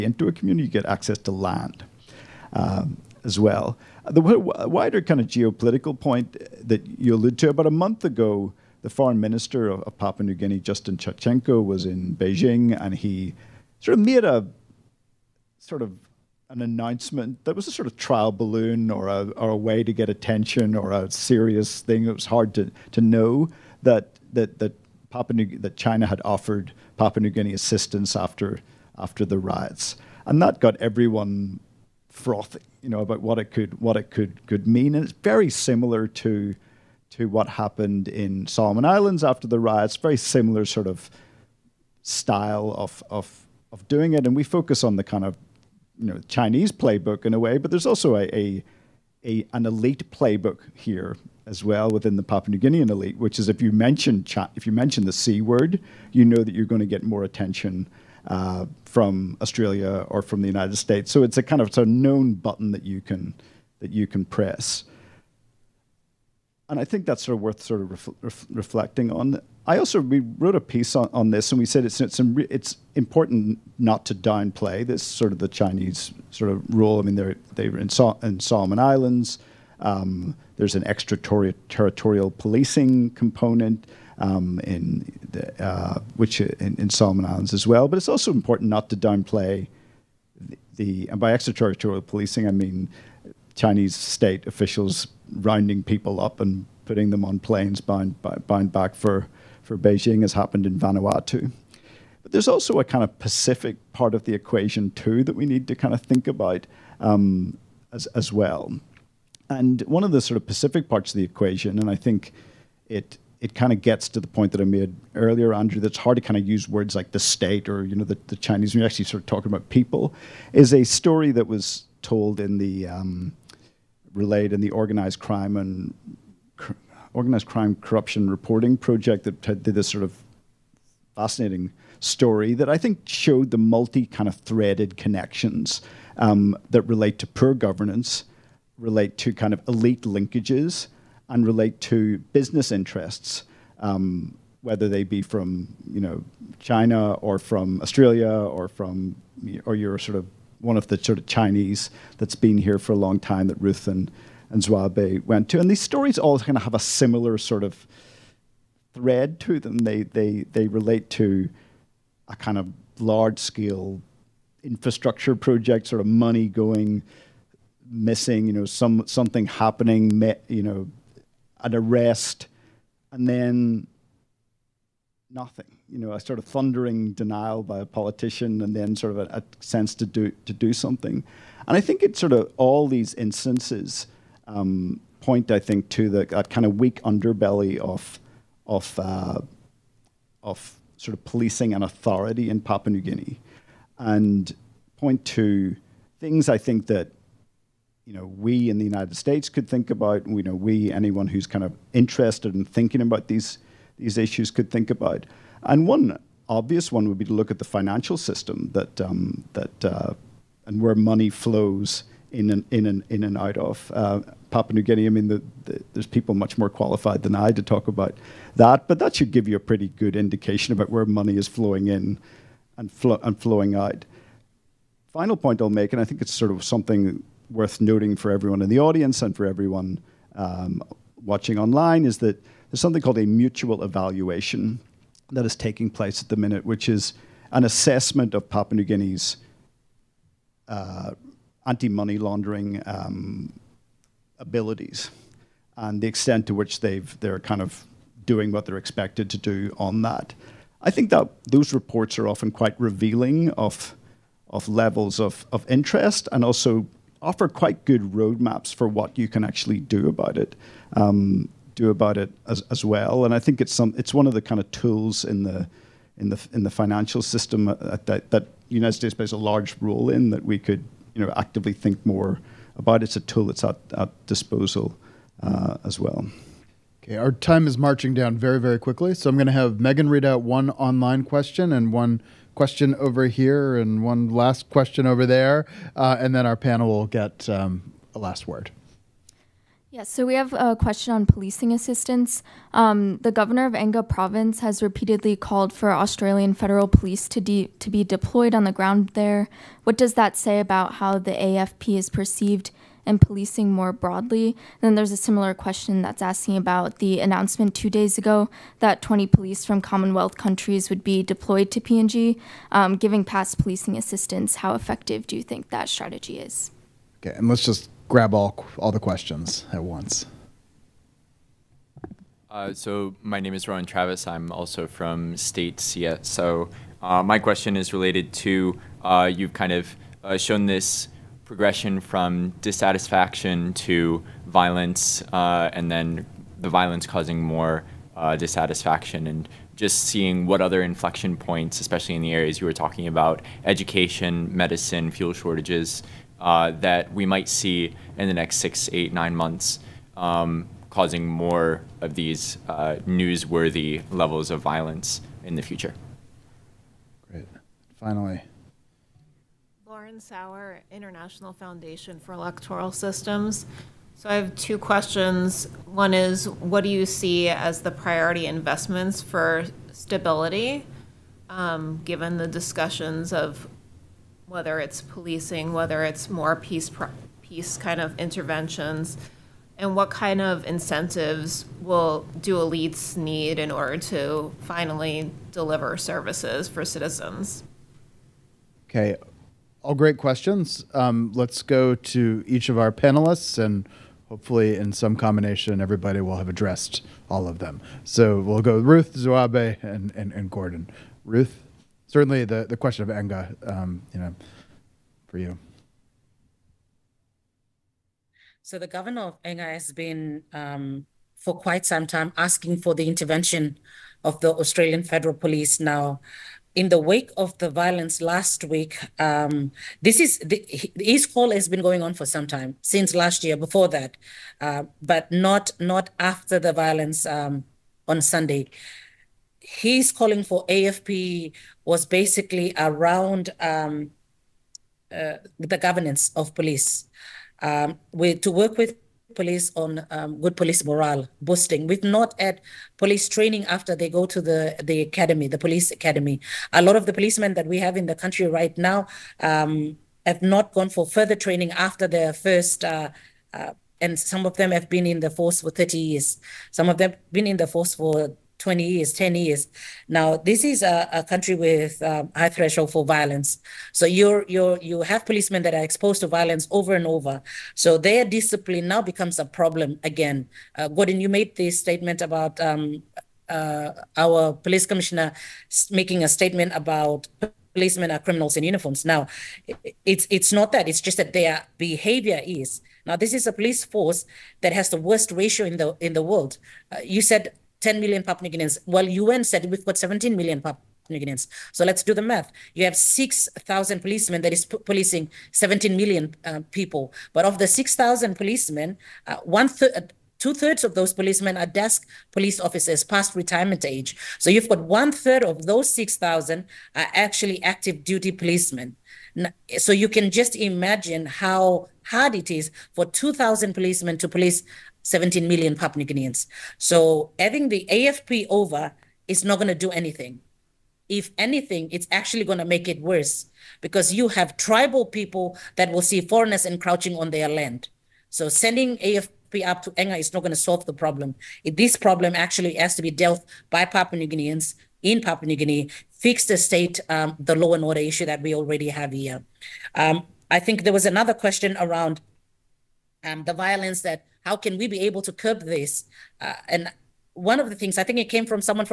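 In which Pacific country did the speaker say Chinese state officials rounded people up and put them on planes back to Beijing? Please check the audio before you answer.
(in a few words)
Vanuatu.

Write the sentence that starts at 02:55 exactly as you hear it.
You know, a sort of thundering denial by a politician, and then sort of a, a sense to do to do something.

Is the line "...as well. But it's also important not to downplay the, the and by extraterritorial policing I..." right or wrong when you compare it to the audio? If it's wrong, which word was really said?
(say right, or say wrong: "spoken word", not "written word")
right.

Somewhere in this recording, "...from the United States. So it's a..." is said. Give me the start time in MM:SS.
01:00.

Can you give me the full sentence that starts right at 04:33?
It's a tool that's at, at disposal uh, as well.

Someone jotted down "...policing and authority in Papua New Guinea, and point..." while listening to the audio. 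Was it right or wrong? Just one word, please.
right.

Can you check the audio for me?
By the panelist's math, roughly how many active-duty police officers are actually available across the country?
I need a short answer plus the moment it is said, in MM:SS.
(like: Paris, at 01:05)
2,000, at 08:33.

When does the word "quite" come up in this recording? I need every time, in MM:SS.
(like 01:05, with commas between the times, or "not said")
04:12, 04:17, 06:51.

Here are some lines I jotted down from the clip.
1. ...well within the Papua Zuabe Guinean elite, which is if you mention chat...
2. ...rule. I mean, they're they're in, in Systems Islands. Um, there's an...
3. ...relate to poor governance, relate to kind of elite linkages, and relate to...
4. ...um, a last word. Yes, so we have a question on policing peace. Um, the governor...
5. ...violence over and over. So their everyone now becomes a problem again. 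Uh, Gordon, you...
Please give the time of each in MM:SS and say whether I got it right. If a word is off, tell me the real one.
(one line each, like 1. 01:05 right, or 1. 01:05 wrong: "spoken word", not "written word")
1. 00:51 wrong: "New", not "Zuabe"
2. 01:16 wrong: "Solomon", not "Systems"
3. 02:16 right
4. 04:47 wrong: "assistance", not "peace"
5. 07:46 wrong: "discipline", not "everyone".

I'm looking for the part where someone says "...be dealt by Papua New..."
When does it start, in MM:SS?
08:53.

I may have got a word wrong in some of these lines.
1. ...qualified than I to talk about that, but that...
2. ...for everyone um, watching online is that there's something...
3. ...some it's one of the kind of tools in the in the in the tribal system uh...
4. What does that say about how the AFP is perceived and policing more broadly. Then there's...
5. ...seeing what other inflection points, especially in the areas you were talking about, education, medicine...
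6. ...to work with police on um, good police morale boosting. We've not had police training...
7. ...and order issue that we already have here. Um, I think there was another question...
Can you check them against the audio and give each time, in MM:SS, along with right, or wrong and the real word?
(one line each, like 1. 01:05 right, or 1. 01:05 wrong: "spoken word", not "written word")
1. 03:36 right
2. 03:49 right
3. 04:23 wrong: "financial", not "tribal"
4. 04:59 right
5. 05:40 right
6. 07:18 right
7. 08:57 right.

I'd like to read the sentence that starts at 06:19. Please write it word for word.
and what kind of incentives will do elites need in order to finally deliver services for citizens?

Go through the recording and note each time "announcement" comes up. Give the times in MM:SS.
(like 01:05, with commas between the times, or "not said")
00:16, 05:07.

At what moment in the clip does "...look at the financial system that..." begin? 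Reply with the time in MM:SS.
03:27.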